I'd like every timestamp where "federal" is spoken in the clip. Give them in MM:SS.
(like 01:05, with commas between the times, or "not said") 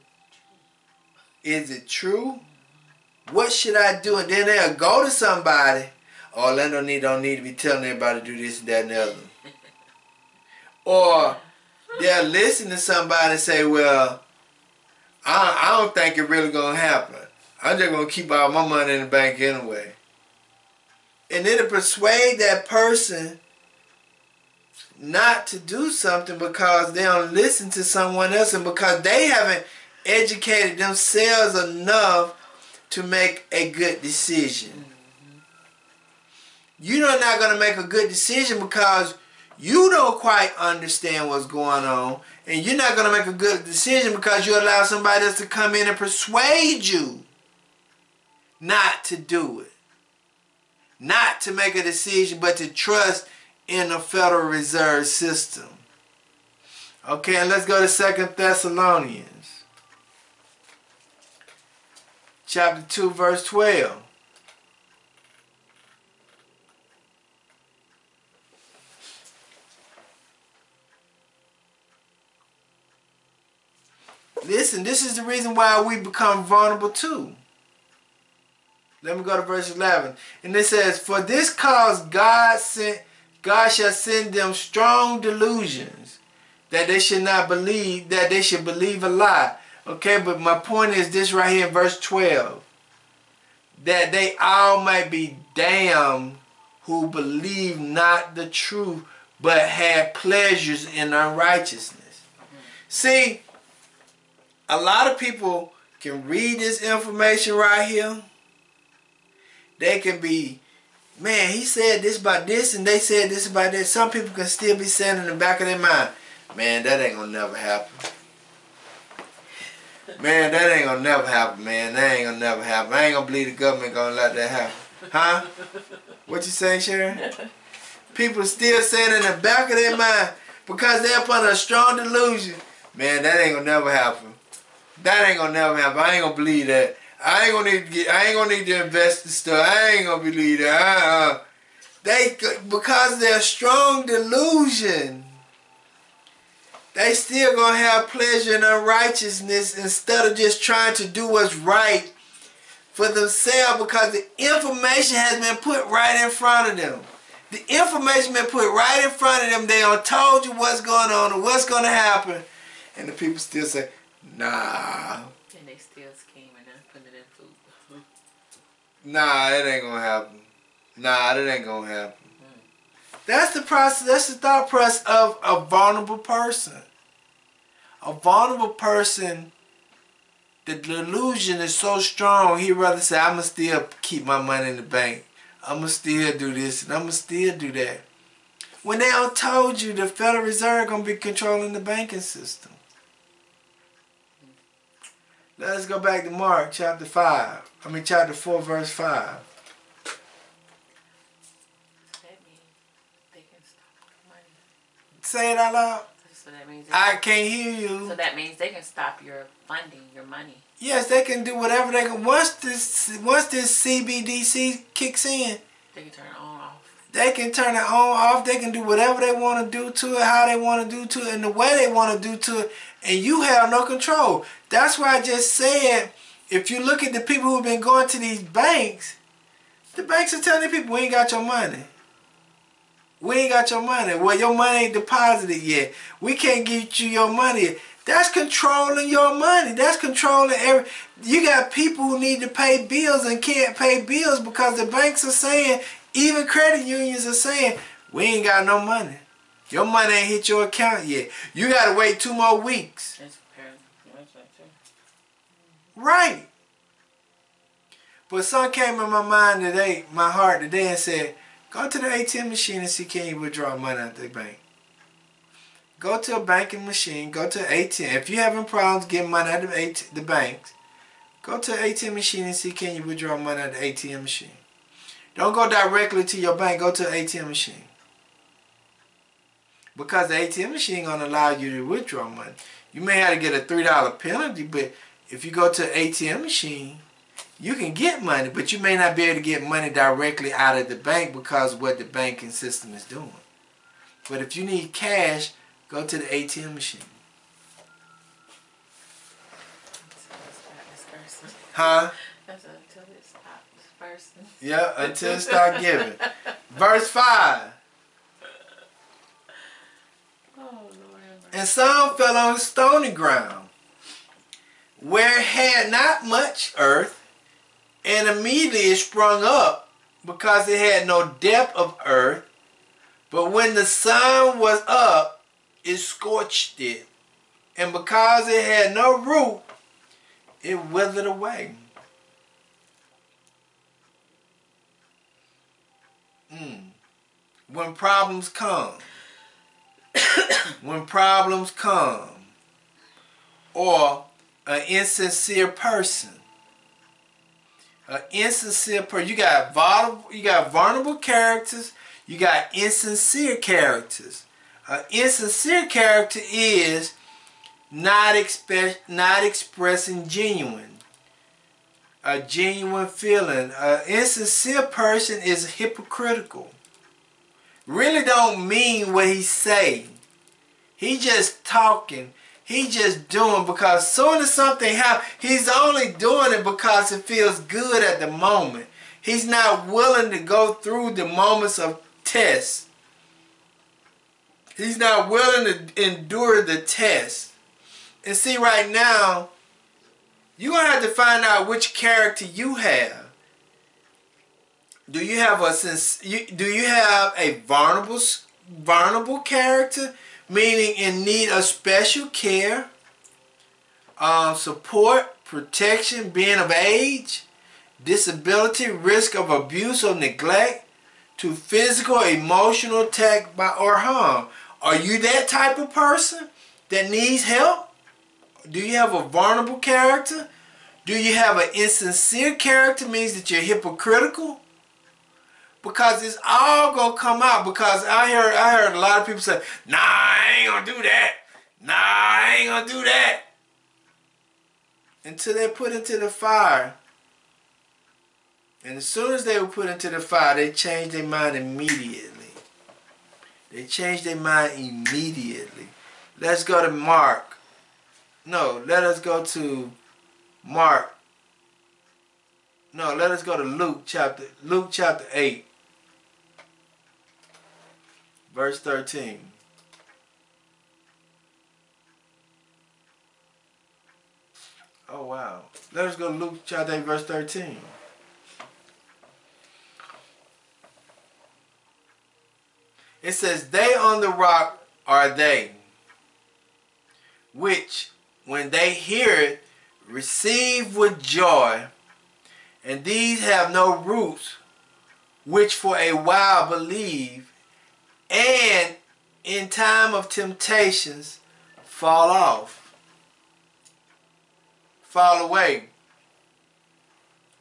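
00:53, 03:10.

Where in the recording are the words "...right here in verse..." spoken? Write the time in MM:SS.
01:31.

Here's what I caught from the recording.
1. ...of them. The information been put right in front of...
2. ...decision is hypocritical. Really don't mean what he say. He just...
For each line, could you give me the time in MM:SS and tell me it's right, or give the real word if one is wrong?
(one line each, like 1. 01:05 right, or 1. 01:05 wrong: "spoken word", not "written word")
1. 02:36 right
2. 06:04 wrong: "person", not "decision".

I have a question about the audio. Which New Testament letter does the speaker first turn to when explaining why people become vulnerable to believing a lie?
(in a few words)
Second Thessalonians.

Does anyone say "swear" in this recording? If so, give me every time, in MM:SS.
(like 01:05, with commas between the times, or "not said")
not said.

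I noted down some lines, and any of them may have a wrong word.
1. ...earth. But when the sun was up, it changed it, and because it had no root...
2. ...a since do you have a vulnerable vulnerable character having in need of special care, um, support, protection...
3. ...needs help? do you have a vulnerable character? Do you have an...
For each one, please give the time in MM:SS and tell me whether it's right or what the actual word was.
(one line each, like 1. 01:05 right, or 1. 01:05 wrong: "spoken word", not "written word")
1. 05:22 wrong: "scorched", not "changed"
2. 06:35 wrong: "meaning", not "having"
3. 06:57 right.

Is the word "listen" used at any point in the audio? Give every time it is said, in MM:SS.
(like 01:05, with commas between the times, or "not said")
00:12, 00:27, 01:14.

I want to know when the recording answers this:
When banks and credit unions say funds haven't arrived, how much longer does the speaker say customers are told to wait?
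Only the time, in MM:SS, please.
04:12.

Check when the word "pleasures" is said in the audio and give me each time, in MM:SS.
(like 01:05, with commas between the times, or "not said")
01:40, 02:28.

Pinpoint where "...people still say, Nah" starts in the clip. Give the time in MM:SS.
02:43.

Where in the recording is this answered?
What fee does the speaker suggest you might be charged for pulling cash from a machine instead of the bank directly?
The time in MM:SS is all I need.
04:43.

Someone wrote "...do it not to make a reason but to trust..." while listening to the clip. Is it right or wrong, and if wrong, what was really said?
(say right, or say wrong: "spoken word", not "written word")
wrong: "decision", not "reason".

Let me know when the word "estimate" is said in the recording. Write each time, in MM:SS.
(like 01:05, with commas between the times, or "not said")
not said.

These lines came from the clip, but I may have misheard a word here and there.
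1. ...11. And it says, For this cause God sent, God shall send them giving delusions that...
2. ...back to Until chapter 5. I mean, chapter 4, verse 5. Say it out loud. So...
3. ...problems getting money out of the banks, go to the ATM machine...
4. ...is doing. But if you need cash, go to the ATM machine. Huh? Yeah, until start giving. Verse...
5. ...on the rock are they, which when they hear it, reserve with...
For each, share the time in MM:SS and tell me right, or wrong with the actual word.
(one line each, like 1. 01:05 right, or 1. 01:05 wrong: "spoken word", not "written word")
1. 01:19 wrong: "strong", not "giving"
2. 03:16 wrong: "Mark", not "Until"
3. 04:28 right
4. 04:52 right
5. 07:53 wrong: "receive", not "reserve".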